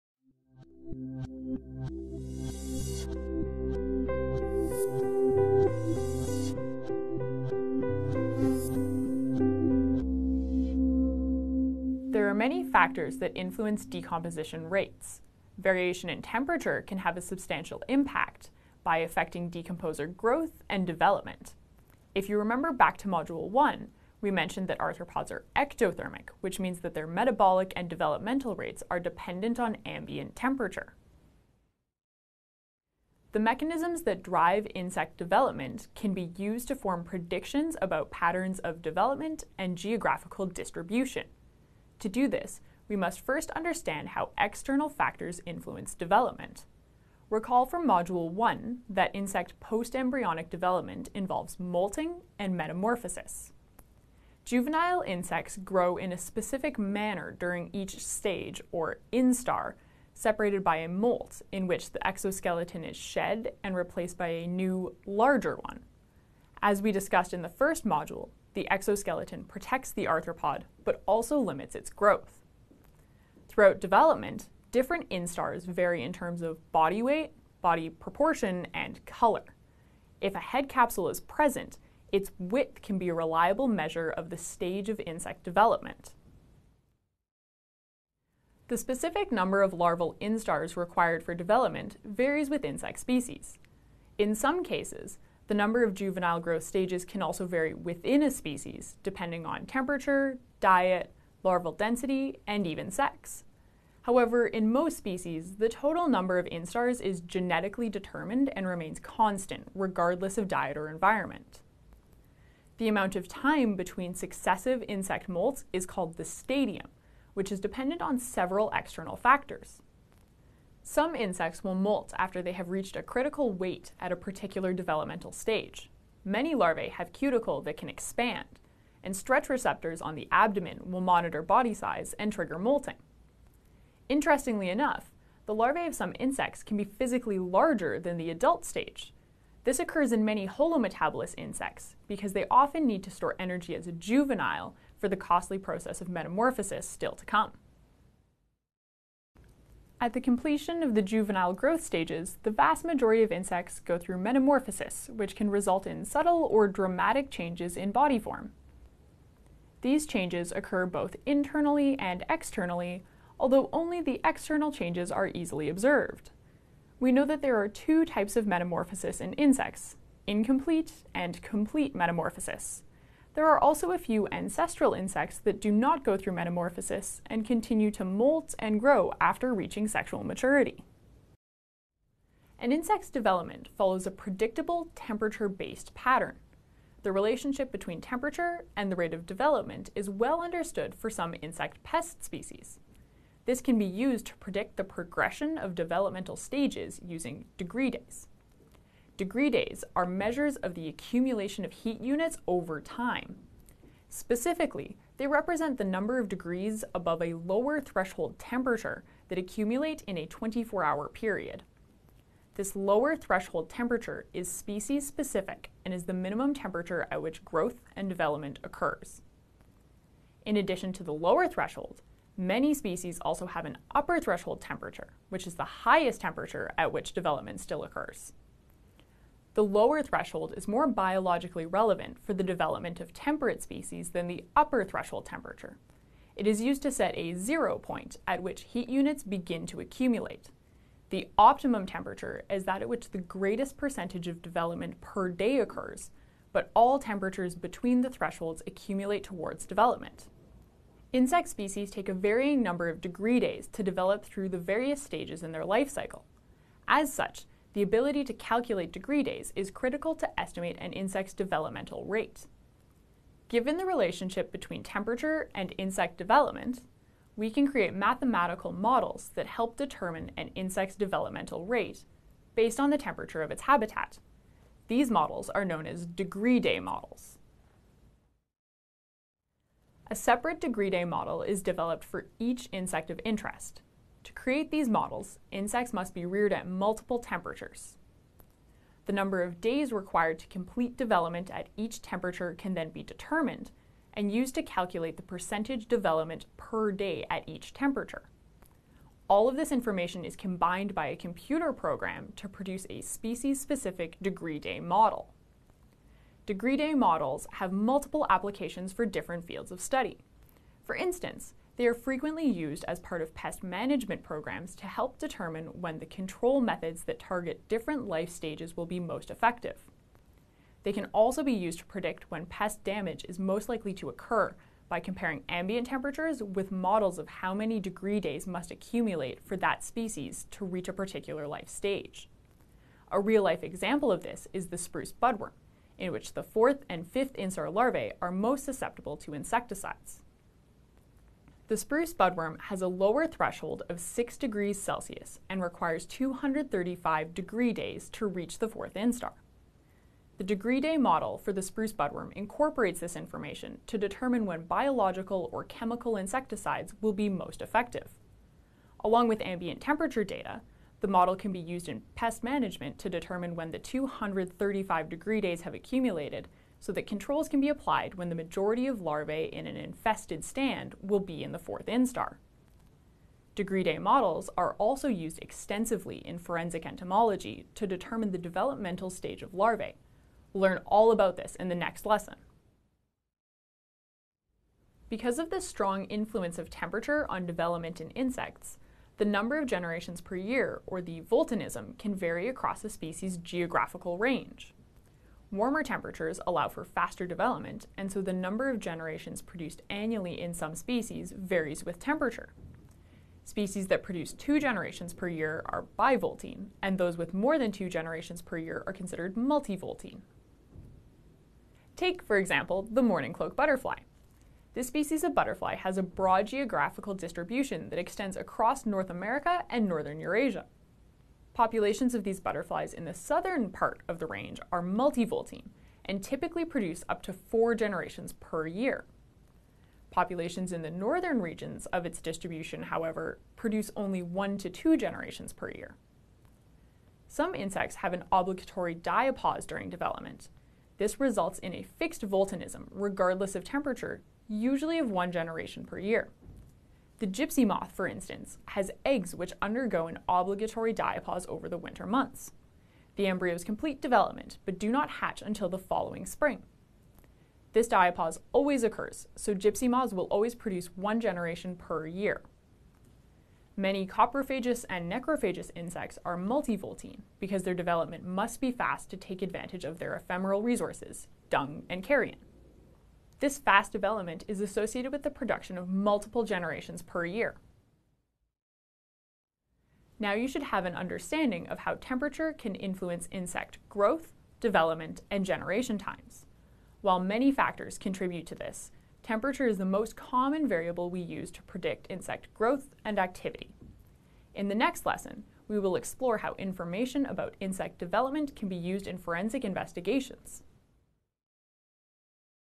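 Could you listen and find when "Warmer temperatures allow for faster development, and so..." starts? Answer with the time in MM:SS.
06:35.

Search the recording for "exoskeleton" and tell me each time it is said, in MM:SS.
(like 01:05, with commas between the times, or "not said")
01:02, 01:08.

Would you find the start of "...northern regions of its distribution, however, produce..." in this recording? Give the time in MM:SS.
07:10.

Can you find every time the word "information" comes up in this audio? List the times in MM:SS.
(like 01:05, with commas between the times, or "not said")
04:59, 05:53, 08:16.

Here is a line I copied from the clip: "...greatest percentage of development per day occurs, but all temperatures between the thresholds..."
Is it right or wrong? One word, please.
right.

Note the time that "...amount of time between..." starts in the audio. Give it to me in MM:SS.
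01:52.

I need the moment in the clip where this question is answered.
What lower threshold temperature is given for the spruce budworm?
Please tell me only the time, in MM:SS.
05:44.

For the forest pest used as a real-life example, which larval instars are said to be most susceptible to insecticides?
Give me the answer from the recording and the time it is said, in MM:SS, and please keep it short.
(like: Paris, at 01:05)
fourth and fifth, at 05:36.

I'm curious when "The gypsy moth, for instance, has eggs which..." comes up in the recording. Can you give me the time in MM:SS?
07:27.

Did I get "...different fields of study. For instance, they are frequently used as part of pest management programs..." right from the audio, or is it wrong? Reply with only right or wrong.
right.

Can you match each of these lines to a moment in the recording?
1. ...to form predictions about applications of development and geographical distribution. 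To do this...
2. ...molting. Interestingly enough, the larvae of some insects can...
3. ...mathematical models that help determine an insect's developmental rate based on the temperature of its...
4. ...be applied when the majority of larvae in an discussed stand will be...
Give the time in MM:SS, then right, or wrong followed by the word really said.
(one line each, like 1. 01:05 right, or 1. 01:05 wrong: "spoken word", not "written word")
1. 00:36 wrong: "patterns", not "applications"
2. 02:12 right
3. 04:27 right
4. 06:07 wrong: "infested", not "discussed".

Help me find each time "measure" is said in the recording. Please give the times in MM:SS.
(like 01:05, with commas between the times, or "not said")
01:23, 03:20.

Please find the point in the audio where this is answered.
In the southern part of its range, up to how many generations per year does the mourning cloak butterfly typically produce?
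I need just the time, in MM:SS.
07:07.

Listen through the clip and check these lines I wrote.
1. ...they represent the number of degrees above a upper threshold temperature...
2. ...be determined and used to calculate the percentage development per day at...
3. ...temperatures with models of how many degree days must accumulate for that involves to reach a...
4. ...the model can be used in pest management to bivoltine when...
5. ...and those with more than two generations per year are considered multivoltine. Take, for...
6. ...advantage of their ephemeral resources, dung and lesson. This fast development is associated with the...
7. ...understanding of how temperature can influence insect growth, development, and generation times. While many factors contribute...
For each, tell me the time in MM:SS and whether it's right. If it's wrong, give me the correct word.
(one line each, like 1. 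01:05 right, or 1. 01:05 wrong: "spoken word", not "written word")
1. 03:25 wrong: "lower", not "upper"
2. 04:52 right
3. 05:25 wrong: "species", not "involves"
4. 06:01 wrong: "determine", not "bivoltine"
5. 06:46 right
6. 07:49 wrong: "carrion", not "lesson"
7. 08:00 right.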